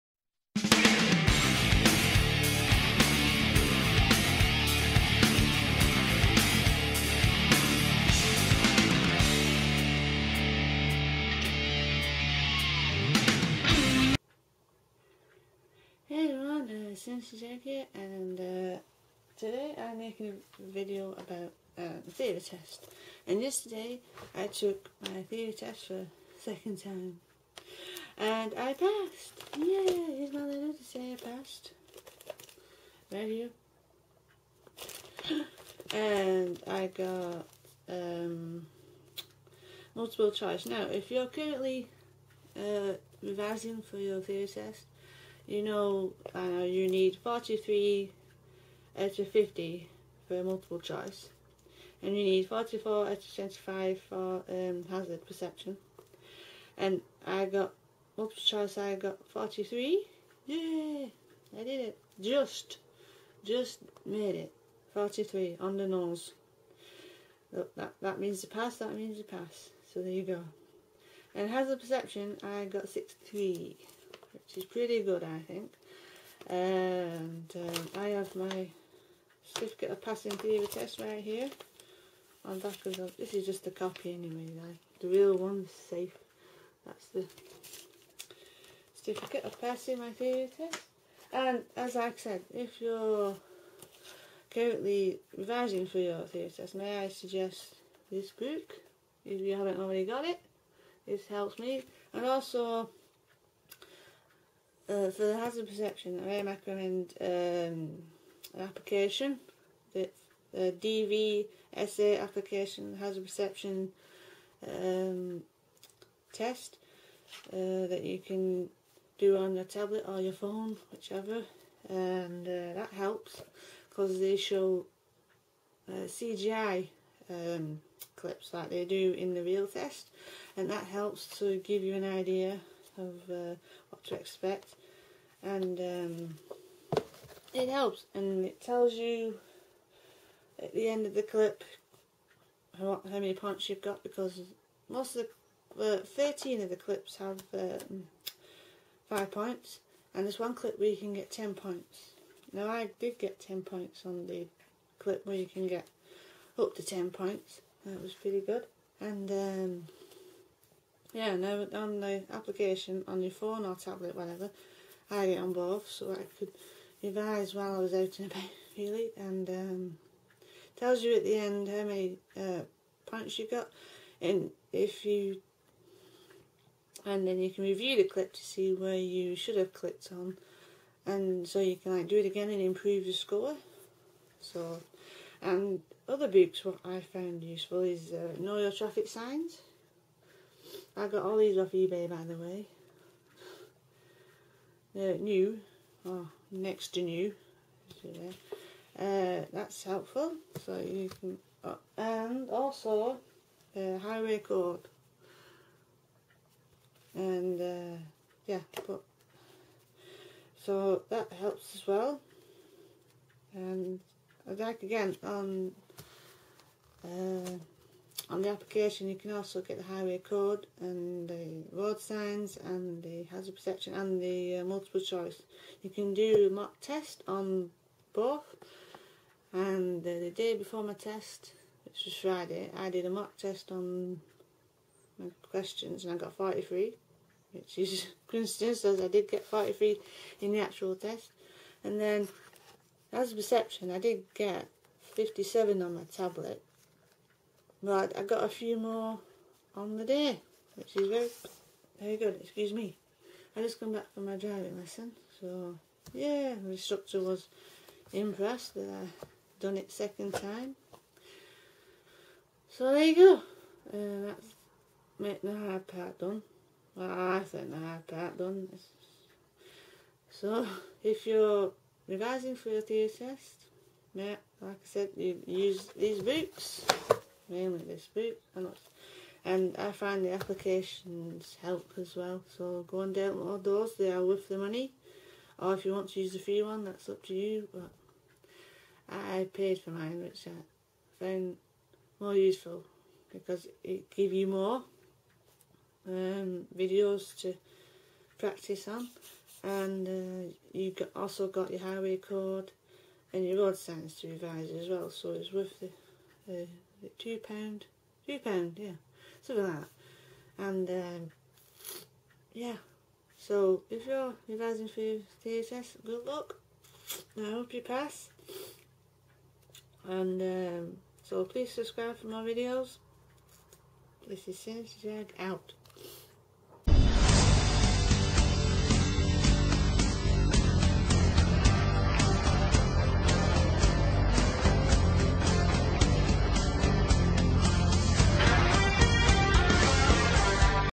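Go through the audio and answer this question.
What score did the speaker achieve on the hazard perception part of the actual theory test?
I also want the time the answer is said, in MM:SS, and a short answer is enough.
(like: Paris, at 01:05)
63, at 01:12.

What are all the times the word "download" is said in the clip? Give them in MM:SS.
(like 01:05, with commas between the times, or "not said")
04:43.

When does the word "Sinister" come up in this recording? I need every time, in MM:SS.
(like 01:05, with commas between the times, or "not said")
00:17, 05:24.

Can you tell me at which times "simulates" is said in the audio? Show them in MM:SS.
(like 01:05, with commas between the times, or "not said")
not said.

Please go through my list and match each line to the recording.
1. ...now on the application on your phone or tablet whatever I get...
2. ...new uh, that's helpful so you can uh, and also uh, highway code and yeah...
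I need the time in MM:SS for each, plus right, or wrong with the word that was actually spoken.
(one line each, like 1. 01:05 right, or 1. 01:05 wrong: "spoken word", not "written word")
1. 02:41 right
2. 03:17 right.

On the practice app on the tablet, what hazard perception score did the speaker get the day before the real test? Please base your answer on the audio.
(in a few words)
57.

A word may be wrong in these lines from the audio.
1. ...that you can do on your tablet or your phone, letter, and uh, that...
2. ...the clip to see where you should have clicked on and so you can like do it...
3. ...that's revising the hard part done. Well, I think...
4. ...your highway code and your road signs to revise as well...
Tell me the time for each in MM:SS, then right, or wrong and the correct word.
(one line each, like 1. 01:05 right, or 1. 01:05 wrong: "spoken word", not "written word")
1. 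01:57 wrong: "whichever", not "letter"
2. 02:57 right
3. 04:24 wrong: "making", not "revising"
4. 05:01 right.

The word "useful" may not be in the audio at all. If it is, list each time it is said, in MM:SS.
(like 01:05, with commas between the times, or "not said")
03:07, 04:52.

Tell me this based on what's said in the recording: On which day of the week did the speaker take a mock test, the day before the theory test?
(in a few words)
Friday.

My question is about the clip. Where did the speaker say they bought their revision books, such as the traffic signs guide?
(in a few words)
eBay.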